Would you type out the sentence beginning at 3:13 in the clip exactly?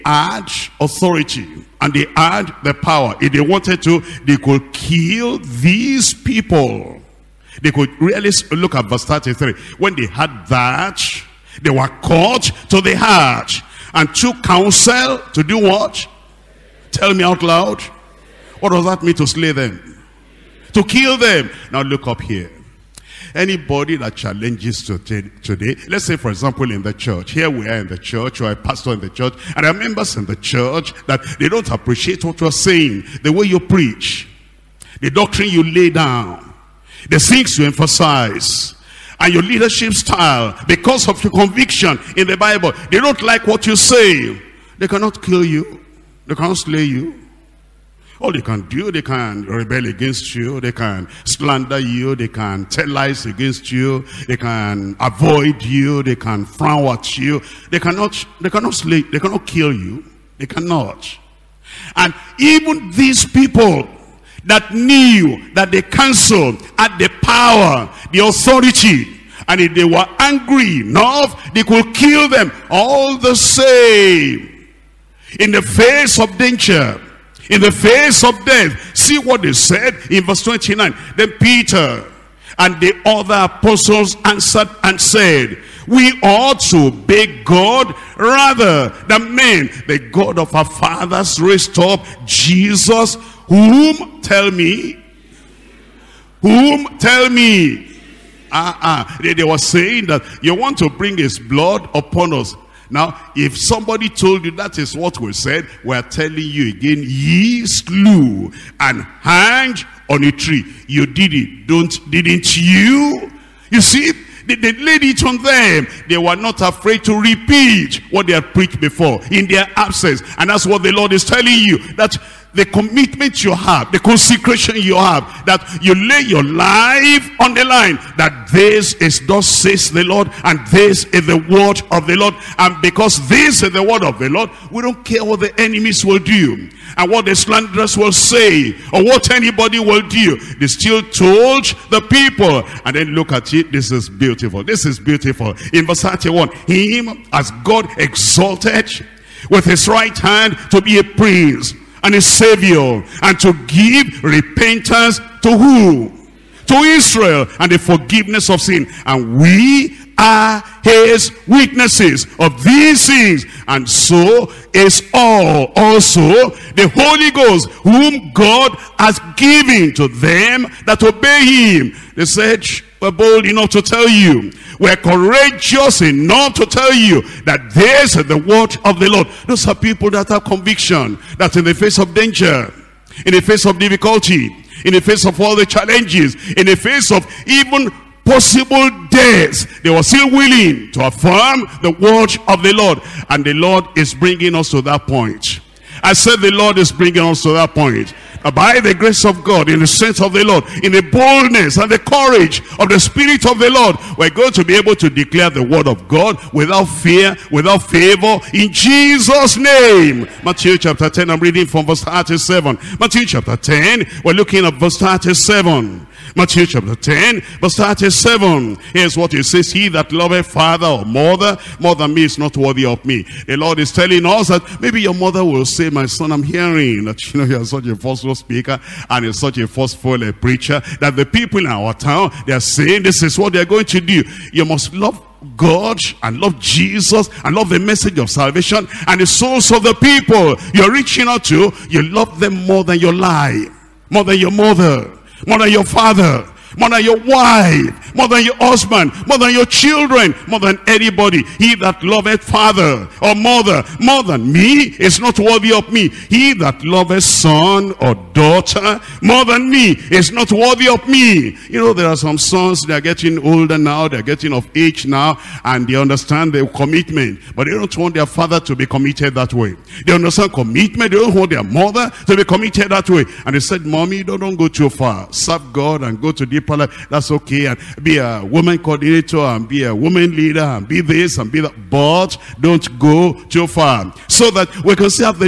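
And the Lord is bringing us to that point.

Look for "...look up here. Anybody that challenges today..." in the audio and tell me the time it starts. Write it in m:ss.
0:21.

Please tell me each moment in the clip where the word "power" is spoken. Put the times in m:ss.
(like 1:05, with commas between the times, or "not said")
0:02, 1:07.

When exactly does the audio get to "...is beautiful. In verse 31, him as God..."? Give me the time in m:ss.
2:24.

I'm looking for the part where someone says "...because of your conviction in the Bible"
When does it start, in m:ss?
0:40.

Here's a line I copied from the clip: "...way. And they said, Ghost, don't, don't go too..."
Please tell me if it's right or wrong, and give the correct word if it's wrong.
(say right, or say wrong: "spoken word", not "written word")
wrong: "Mommy", not "Ghost".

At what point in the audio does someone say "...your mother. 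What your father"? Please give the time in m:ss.
4:04.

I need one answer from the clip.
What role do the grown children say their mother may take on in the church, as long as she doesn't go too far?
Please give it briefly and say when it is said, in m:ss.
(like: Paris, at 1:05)
woman coordinator, at 4:38.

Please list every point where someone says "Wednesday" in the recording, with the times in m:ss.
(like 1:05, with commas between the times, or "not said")
not said.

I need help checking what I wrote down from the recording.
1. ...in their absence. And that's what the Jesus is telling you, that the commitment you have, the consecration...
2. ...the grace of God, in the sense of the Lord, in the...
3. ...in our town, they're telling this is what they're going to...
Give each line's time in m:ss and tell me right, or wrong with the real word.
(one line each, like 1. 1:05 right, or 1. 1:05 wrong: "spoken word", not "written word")
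1. 1:59 wrong: "Lord", not "Jesus"
2. 3:18 right
3. 3:51 wrong: "saying", not "telling".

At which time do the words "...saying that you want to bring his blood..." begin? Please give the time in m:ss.
1:39.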